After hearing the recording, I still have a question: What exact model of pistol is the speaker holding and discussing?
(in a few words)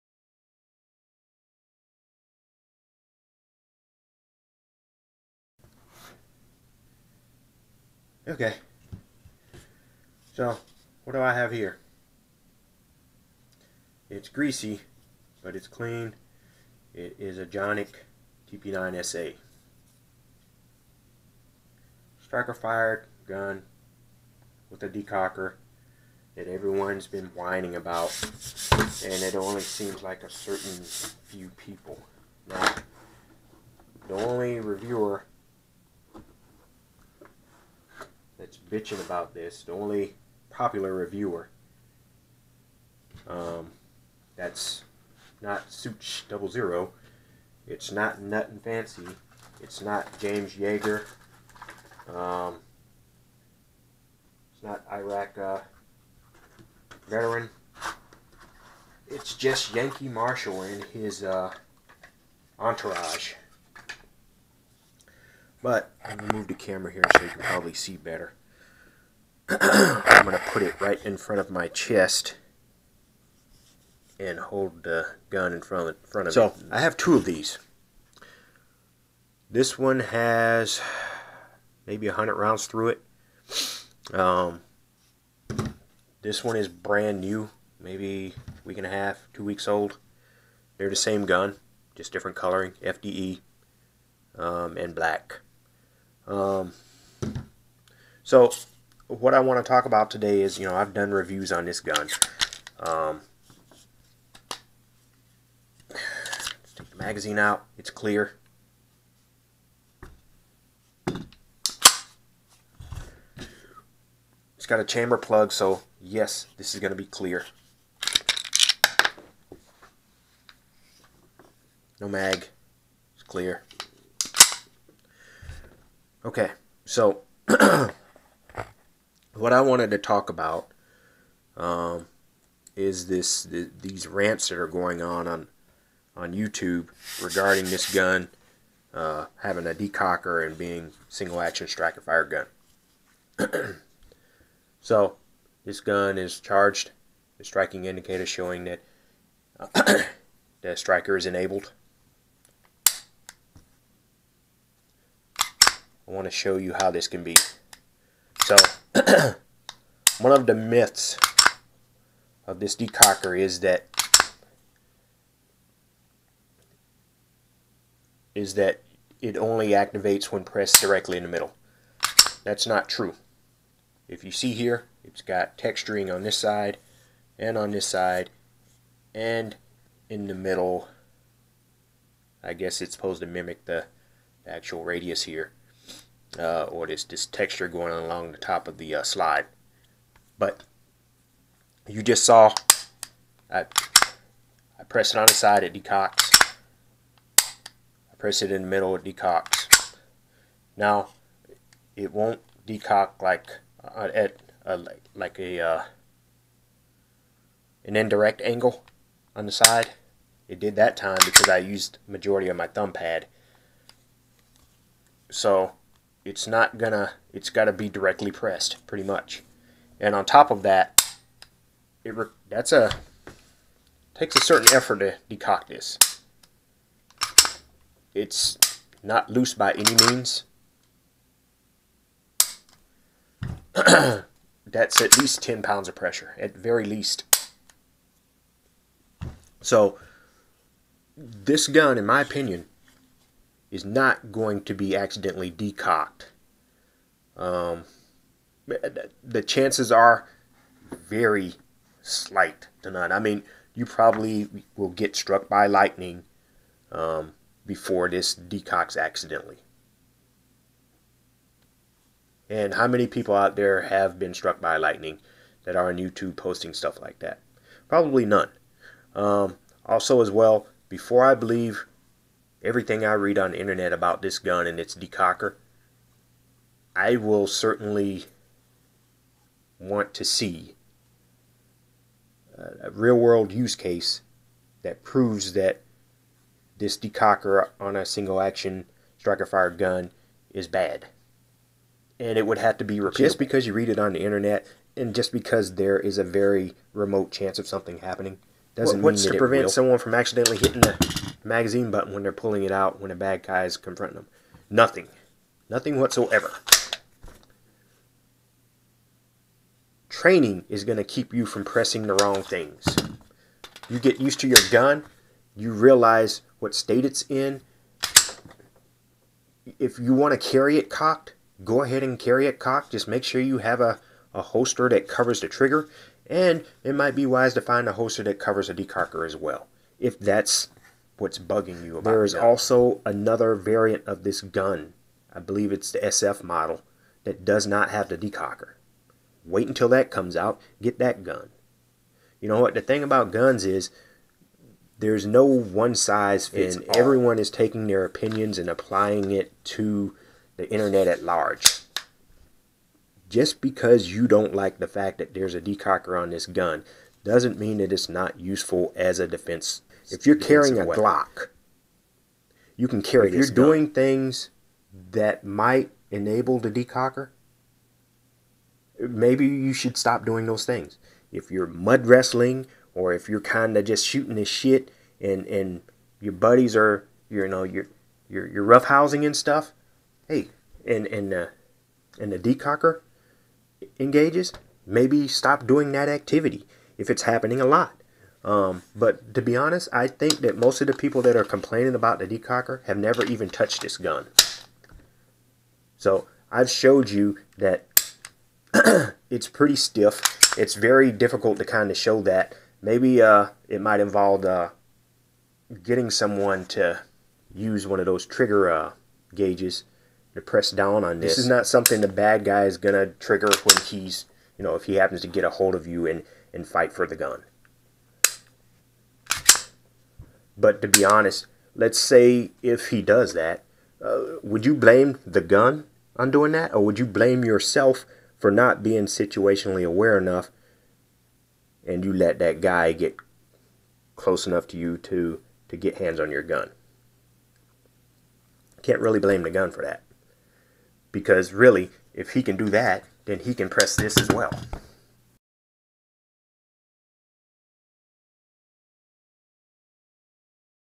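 Canik TP9SA.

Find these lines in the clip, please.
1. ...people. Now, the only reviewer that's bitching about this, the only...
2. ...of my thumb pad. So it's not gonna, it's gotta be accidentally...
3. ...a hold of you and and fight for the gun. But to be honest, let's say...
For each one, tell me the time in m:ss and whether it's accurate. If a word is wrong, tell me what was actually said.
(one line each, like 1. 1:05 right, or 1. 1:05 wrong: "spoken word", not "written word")
1. 0:31 right
2. 3:32 wrong: "directly", not "accidentally"
3. 6:55 right.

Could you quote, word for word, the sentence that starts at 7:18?
Can't really blame the gun for that because really, if he can do that, then he can press this as well.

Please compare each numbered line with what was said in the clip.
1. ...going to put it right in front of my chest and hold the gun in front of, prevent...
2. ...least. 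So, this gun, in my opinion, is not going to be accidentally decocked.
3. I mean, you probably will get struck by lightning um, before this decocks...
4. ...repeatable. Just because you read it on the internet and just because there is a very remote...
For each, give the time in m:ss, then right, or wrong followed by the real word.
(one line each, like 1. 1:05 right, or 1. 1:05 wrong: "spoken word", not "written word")
1. 1:10 wrong: "front", not "prevent"
2. 3:56 right
3. 4:13 right
4. 4:52 right.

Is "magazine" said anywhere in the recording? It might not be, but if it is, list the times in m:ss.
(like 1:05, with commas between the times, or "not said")
1:46, 5:01.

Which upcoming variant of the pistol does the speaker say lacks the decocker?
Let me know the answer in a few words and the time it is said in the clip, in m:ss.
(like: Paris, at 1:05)
SF model, at 5:35.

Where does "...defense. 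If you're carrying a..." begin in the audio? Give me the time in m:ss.
5:59.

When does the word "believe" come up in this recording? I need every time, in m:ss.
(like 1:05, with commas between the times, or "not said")
4:31, 5:35.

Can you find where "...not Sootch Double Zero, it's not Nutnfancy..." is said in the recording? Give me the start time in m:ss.
0:45.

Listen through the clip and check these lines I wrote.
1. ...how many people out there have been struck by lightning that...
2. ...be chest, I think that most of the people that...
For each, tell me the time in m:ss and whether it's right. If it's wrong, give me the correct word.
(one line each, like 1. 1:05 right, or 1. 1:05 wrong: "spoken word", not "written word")
1. 4:22 right
2. 6:29 wrong: "honest", not "chest".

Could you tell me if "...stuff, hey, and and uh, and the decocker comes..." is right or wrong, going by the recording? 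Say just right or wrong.
wrong.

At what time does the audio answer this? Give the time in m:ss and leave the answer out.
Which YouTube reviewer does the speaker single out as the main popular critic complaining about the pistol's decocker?
0:59.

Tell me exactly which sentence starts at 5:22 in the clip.
Just make sure you have a, a holster that covers the trigger.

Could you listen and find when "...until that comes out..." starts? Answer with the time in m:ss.
5:39.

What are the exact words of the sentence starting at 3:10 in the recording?
But you just saw I, I press it on the side, it decocks.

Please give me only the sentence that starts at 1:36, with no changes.
Um, so what I want to talk about today is, you know, I've done reviews on this gun.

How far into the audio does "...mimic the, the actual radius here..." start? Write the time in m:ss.
3:03.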